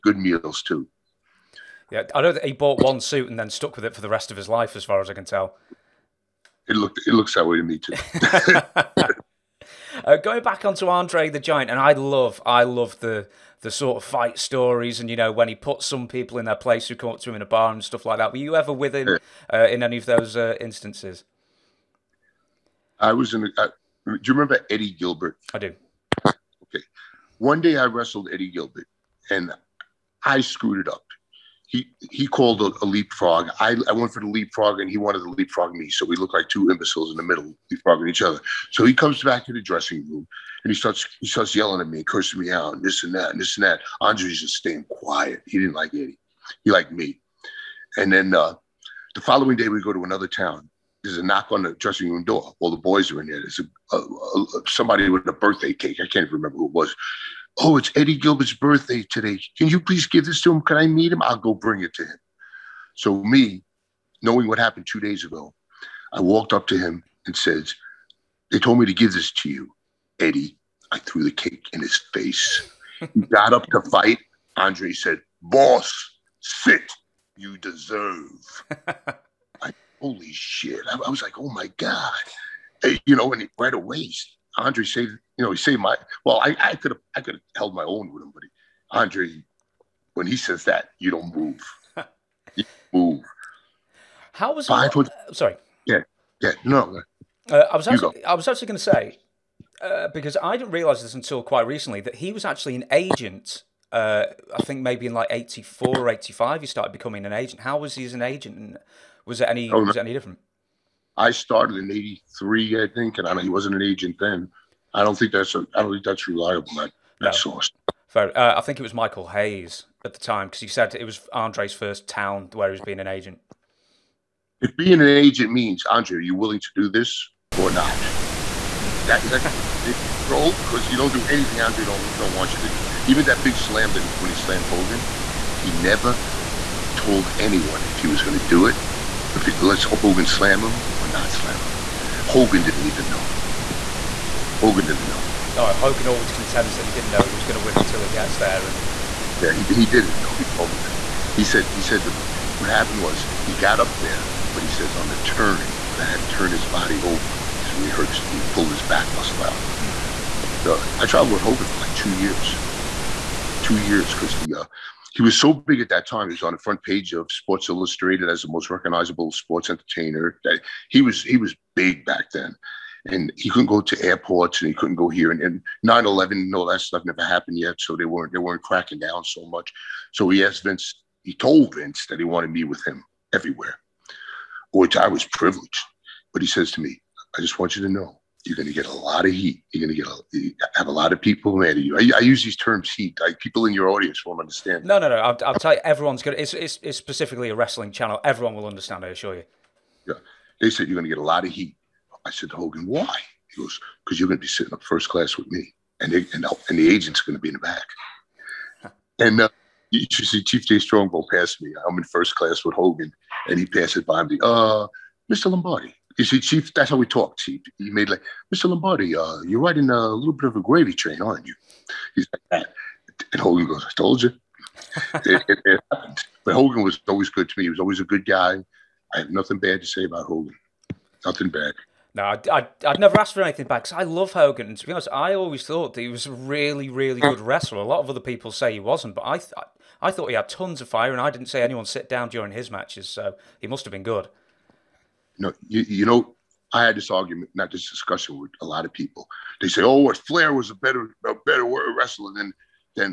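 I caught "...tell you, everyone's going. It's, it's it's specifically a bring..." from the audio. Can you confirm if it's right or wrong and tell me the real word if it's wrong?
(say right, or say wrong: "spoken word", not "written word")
wrong: "wrestling", not "bring".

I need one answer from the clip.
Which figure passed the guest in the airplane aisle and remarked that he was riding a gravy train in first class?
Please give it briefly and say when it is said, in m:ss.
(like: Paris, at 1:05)
Chief Jay Strongbow, at 3:30.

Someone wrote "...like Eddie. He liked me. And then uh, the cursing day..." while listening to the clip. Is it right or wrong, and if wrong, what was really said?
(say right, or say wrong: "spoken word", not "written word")
wrong: "following", not "cursing".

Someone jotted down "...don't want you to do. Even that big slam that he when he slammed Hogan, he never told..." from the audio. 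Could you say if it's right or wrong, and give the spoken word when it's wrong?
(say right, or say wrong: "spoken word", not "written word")
right.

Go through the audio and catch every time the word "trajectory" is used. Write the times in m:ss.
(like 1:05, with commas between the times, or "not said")
not said.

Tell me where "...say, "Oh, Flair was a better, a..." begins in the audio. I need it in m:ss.
4:09.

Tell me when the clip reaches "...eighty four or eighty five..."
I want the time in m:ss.
1:45.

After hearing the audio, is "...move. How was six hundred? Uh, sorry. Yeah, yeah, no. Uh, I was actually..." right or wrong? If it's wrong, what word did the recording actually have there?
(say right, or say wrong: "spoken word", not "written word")
wrong: "five", not "six".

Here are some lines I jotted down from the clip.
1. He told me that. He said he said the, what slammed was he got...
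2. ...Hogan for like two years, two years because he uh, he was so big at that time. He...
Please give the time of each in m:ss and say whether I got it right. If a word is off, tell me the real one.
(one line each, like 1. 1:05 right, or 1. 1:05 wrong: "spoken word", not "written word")
1. 2:30 wrong: "happened", not "slammed"
2. 2:41 right.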